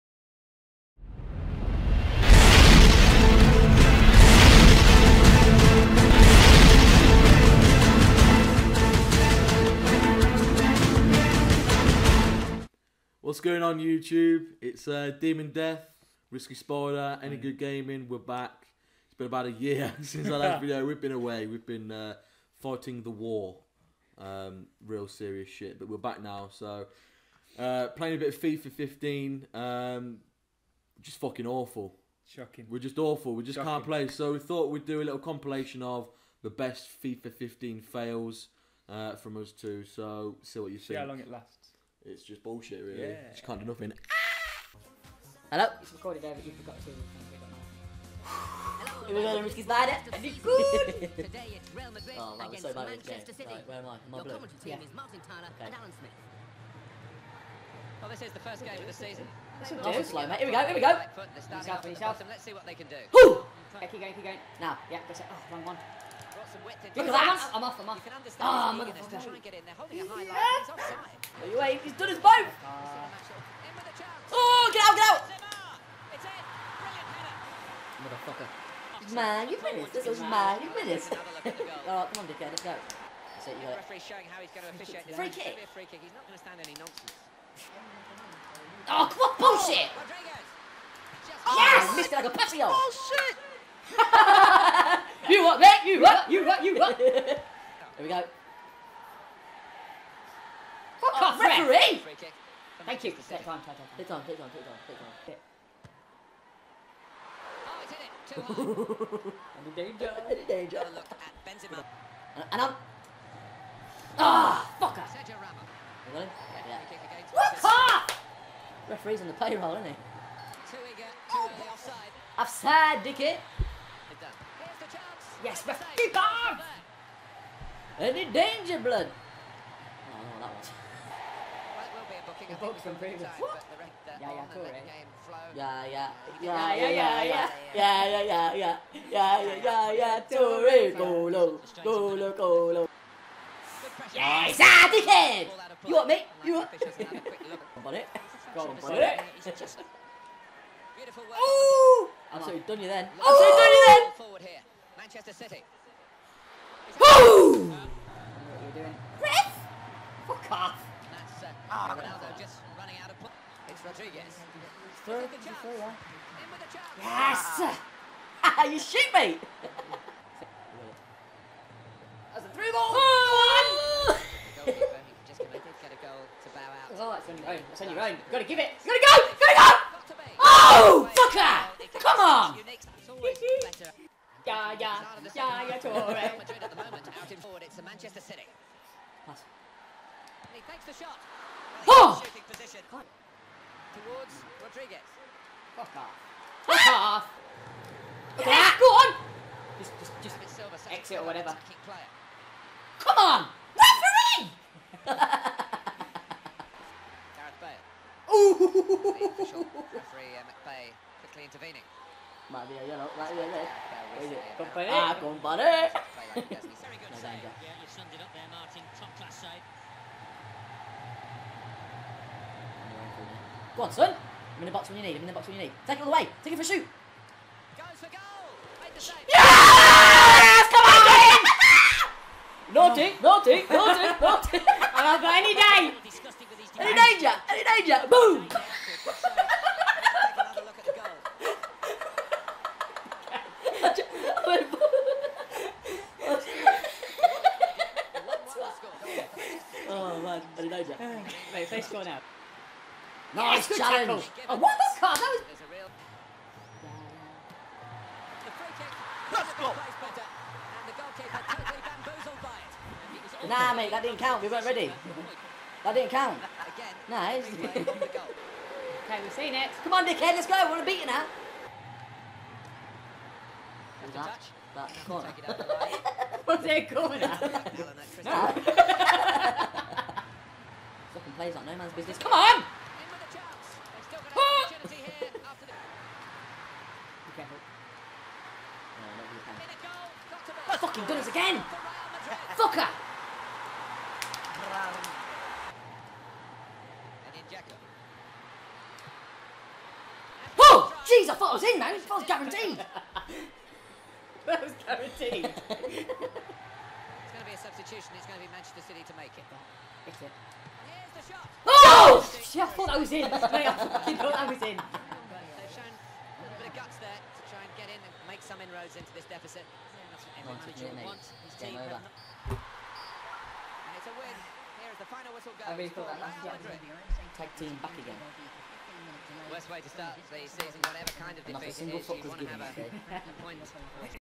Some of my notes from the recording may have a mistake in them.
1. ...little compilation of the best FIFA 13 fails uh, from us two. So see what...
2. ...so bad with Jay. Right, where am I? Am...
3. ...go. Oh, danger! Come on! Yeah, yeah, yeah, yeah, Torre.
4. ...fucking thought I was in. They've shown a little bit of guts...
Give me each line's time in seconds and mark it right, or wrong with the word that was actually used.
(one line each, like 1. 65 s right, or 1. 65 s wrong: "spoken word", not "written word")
1. 35 s wrong: "15", not "13"
2. 52 s right
3. 180 s wrong: "fucker", not "danger"
4. 313 s right.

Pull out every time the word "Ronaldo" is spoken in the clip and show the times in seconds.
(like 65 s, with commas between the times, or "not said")
161 s.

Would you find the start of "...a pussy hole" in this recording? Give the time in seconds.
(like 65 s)
92 s.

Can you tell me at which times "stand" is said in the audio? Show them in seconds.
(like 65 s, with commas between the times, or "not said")
86 s.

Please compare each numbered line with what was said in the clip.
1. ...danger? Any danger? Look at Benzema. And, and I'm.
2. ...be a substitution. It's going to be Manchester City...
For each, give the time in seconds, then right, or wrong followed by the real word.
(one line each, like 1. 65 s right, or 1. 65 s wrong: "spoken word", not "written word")
1. 109 s right
2. 307 s right.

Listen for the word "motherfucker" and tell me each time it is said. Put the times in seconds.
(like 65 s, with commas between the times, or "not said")
68 s, 78 s.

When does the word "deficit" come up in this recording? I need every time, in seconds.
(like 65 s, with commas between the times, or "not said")
319 s.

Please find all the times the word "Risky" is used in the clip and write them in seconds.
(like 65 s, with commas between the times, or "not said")
16 s, 49 s.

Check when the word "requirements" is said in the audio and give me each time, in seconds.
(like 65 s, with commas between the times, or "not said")
not said.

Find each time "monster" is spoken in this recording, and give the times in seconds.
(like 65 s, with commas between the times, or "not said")
not said.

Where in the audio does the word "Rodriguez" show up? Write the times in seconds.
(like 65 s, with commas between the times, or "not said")
163 s, 194 s.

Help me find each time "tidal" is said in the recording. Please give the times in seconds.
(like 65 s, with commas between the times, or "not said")
not said.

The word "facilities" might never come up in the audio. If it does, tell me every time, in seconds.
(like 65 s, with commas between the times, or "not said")
not said.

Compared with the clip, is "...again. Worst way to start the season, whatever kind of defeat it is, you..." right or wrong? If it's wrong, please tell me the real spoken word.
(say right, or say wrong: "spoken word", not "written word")
right.